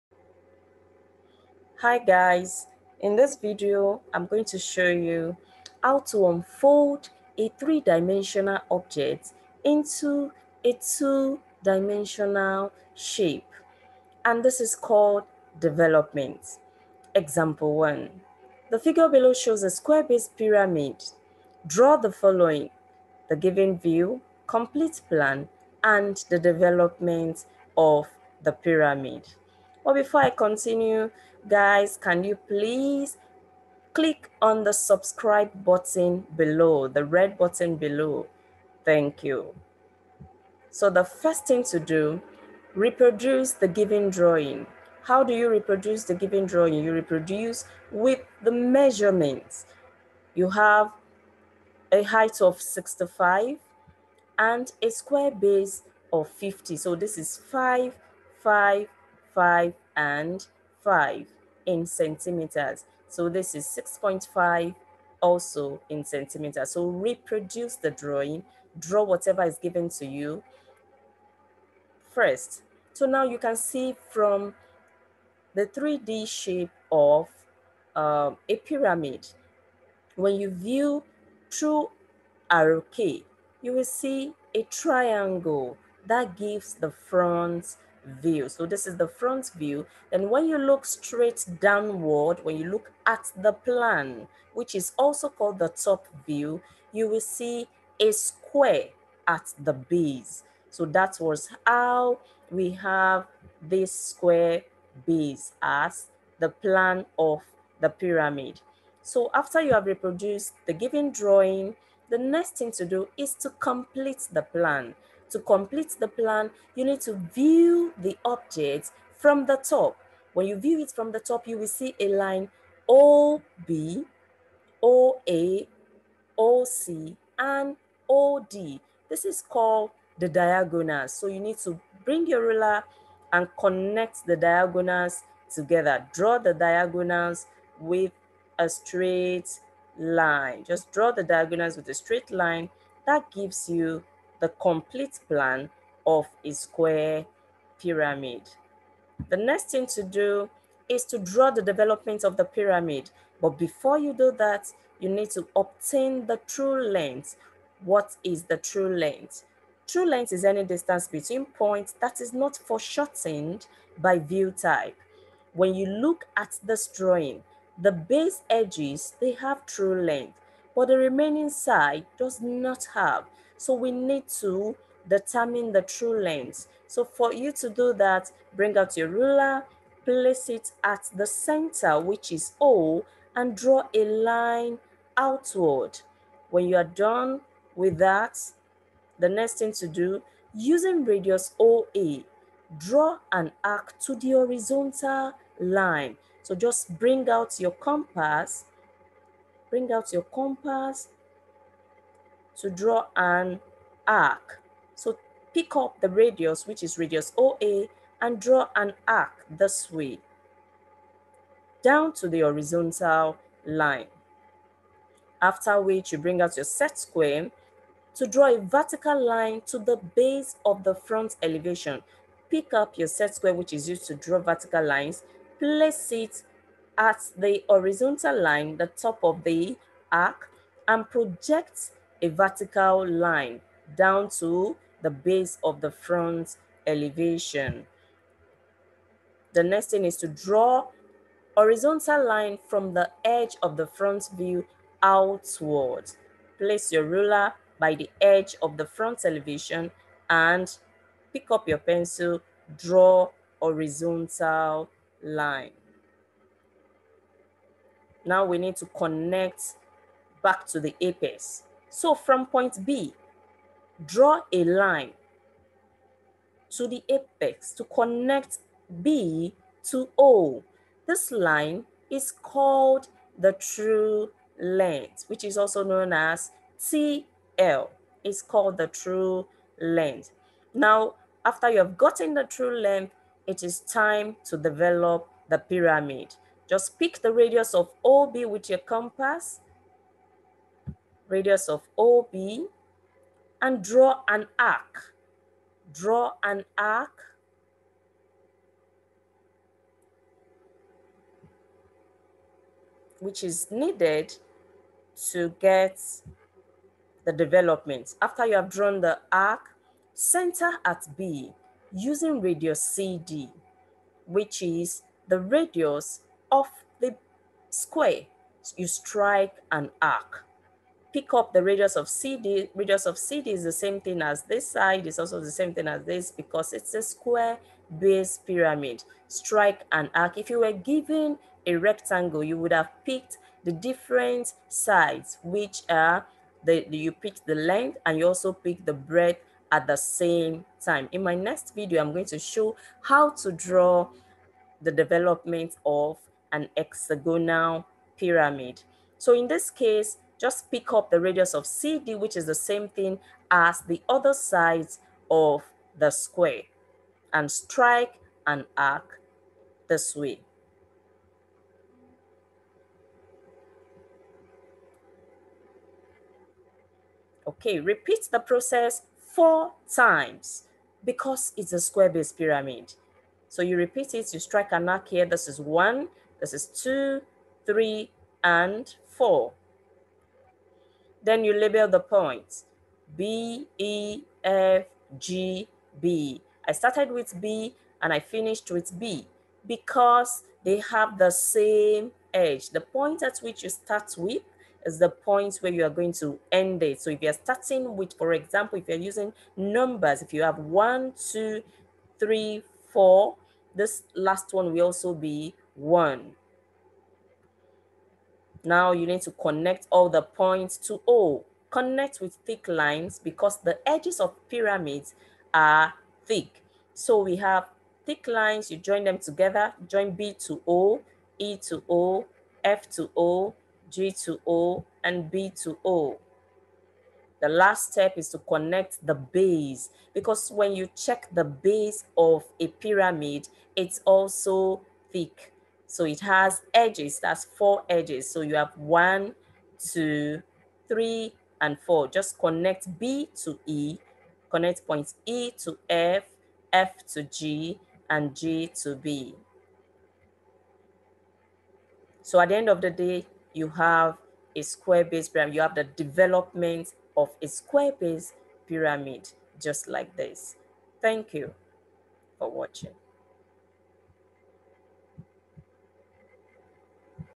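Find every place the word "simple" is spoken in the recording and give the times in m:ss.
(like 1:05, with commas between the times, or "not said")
not said.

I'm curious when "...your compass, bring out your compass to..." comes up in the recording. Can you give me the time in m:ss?
3:17.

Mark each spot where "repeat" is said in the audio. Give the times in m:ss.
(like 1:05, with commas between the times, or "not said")
6:07, 6:13.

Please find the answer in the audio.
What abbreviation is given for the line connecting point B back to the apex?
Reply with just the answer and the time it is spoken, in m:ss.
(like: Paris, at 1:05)
TL, at 4:36.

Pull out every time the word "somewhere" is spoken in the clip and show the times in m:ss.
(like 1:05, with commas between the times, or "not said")
not said.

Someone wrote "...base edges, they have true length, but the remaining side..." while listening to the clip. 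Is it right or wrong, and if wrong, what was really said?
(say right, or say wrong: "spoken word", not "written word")
right.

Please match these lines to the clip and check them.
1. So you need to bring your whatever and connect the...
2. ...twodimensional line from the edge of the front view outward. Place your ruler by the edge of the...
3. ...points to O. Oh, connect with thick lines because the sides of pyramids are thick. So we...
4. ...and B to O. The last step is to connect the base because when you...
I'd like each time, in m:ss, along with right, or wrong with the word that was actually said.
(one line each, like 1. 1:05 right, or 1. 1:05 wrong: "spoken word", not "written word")
1. 2:11 wrong: "ruler", not "whatever"
2. 4:01 wrong: "horizontal", not "twodimensional"
3. 6:50 wrong: "edges", not "sides"
4. 7:05 right.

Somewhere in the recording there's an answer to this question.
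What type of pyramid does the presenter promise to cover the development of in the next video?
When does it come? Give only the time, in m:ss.
5:46.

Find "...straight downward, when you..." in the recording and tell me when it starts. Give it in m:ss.
1:30.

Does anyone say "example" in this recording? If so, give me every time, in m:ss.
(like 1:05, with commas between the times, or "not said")
0:17, 6:38.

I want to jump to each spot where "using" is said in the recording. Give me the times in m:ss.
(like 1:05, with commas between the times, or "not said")
3:10, 5:11, 6:38.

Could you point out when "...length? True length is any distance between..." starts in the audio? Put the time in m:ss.
2:38.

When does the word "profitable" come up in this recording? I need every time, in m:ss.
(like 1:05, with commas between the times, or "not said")
not said.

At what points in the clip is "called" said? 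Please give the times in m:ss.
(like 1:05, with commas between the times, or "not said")
0:14, 1:35, 2:09, 4:32, 4:38.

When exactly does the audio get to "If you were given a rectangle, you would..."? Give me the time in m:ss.
5:30.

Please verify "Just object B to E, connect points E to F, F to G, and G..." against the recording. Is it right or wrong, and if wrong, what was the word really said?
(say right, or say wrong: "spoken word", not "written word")
wrong: "connect", not "object".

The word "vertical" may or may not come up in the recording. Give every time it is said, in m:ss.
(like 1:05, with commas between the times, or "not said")
3:38, 3:44, 3:52.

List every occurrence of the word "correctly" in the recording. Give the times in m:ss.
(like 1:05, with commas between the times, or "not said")
not said.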